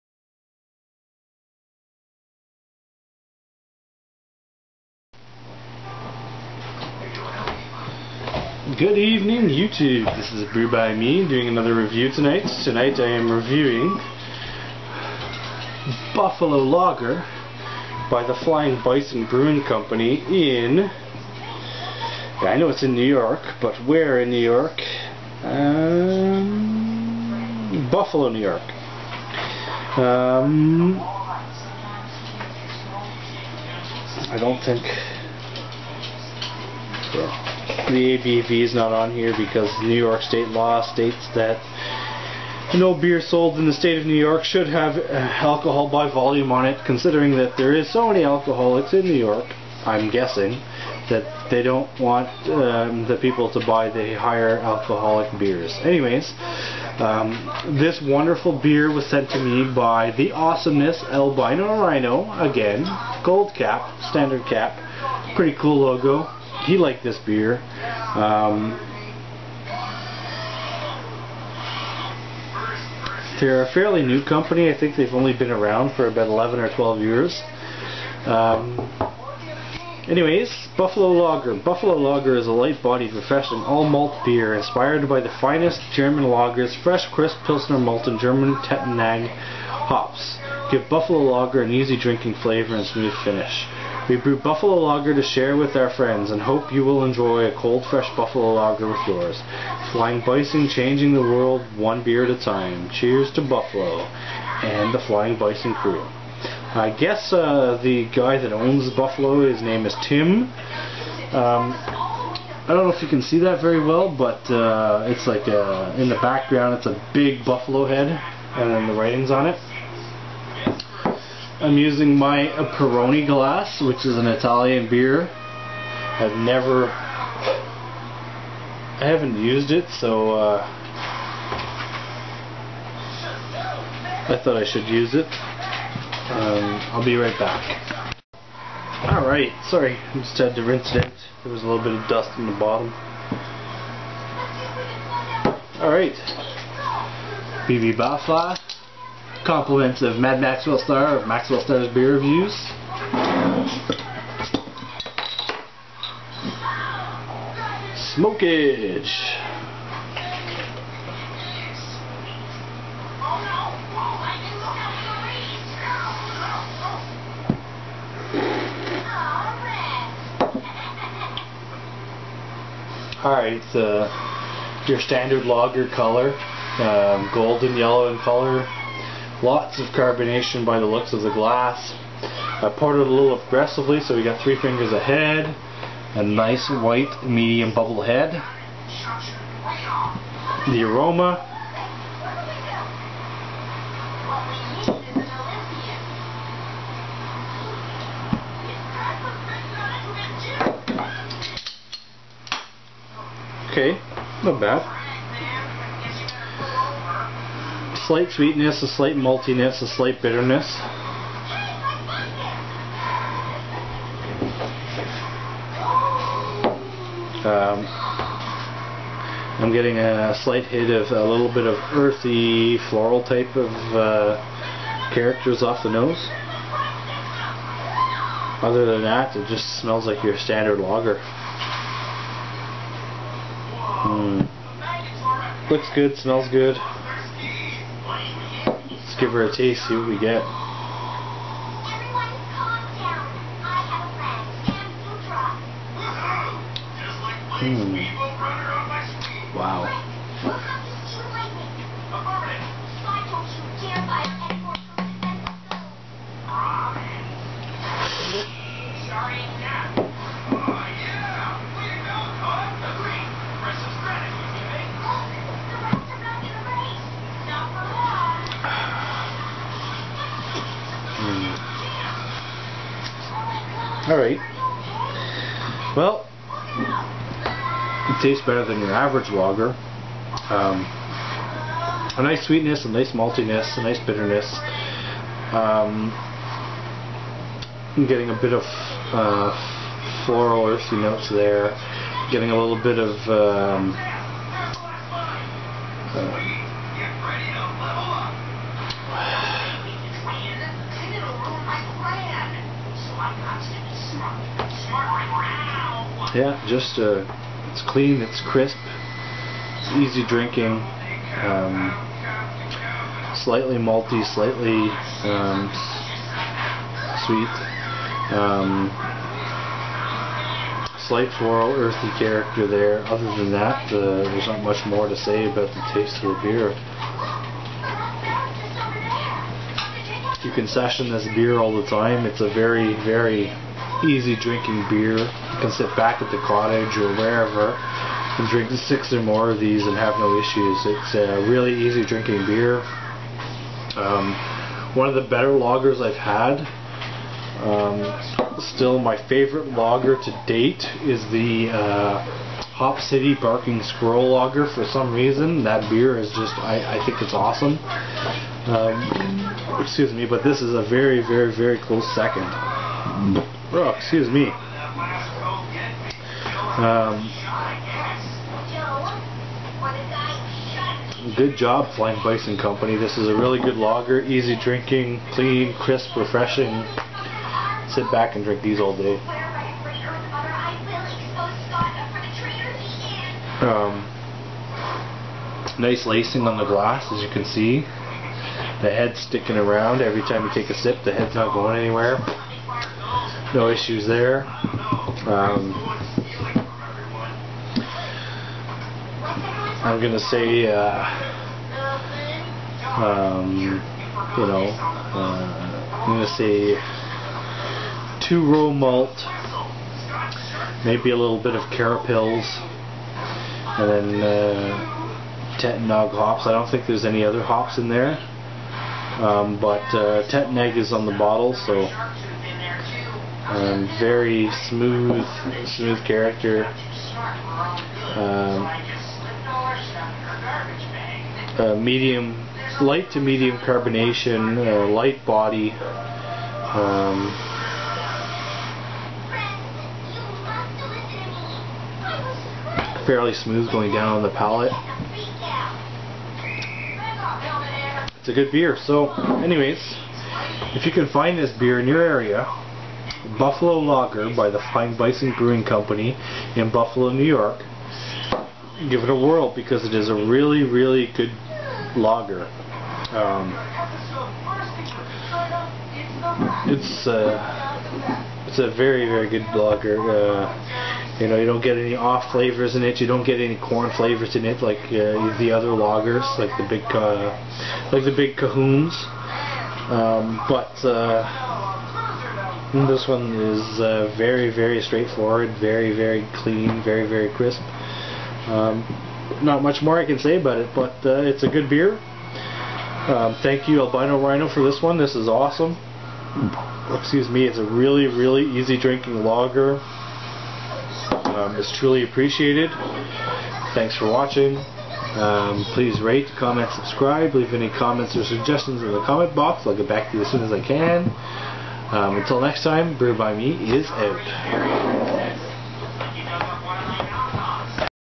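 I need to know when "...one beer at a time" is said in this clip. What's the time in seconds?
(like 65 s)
101 s.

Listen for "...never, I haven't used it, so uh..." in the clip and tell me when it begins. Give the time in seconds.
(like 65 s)
126 s.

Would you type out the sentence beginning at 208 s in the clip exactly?
slight sweetness, a slight maltiness, a slight bitterness.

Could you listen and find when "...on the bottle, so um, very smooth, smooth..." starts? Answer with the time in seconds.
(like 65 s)
420 s.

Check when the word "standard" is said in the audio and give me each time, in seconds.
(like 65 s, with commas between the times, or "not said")
64 s, 174 s, 230 s.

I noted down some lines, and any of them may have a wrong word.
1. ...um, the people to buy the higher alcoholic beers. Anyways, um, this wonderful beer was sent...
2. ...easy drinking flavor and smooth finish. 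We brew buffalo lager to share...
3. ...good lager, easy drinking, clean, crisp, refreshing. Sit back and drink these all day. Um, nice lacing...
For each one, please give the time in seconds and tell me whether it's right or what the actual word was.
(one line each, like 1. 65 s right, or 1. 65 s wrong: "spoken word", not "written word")
1. 52 s right
2. 91 s right
3. 373 s right.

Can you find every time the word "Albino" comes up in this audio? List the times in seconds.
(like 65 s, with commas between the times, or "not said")
61 s, 493 s.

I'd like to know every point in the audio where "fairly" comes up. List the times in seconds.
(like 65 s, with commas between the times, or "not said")
73 s, 443 s.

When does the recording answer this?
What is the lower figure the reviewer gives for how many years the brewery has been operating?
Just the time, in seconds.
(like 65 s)
76 s.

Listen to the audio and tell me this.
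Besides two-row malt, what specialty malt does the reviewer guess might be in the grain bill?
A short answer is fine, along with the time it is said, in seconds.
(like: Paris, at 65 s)
Carapils, at 411 s.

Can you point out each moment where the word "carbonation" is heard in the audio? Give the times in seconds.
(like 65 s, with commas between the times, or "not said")
179 s, 433 s.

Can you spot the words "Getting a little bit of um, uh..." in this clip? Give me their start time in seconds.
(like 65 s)
292 s.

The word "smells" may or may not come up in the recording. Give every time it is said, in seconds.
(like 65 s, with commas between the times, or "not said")
229 s, 236 s.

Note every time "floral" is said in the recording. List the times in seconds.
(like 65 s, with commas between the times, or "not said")
222 s, 290 s, 321 s.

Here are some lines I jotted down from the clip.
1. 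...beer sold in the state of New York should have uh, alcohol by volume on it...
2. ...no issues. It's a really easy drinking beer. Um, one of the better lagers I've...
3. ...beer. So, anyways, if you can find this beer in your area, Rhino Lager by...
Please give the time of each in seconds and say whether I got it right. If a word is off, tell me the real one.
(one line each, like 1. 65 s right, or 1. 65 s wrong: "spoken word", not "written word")
1. 42 s right
2. 340 s right
3. 448 s wrong: "Buffalo", not "Rhino".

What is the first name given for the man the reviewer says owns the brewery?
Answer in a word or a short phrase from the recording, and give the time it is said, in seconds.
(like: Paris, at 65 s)
Tim, at 110 s.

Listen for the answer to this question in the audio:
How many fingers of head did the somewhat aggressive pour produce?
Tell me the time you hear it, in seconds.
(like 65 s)
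184 s.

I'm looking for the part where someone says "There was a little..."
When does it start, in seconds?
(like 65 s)
141 s.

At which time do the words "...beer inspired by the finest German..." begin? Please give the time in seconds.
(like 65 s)
84 s.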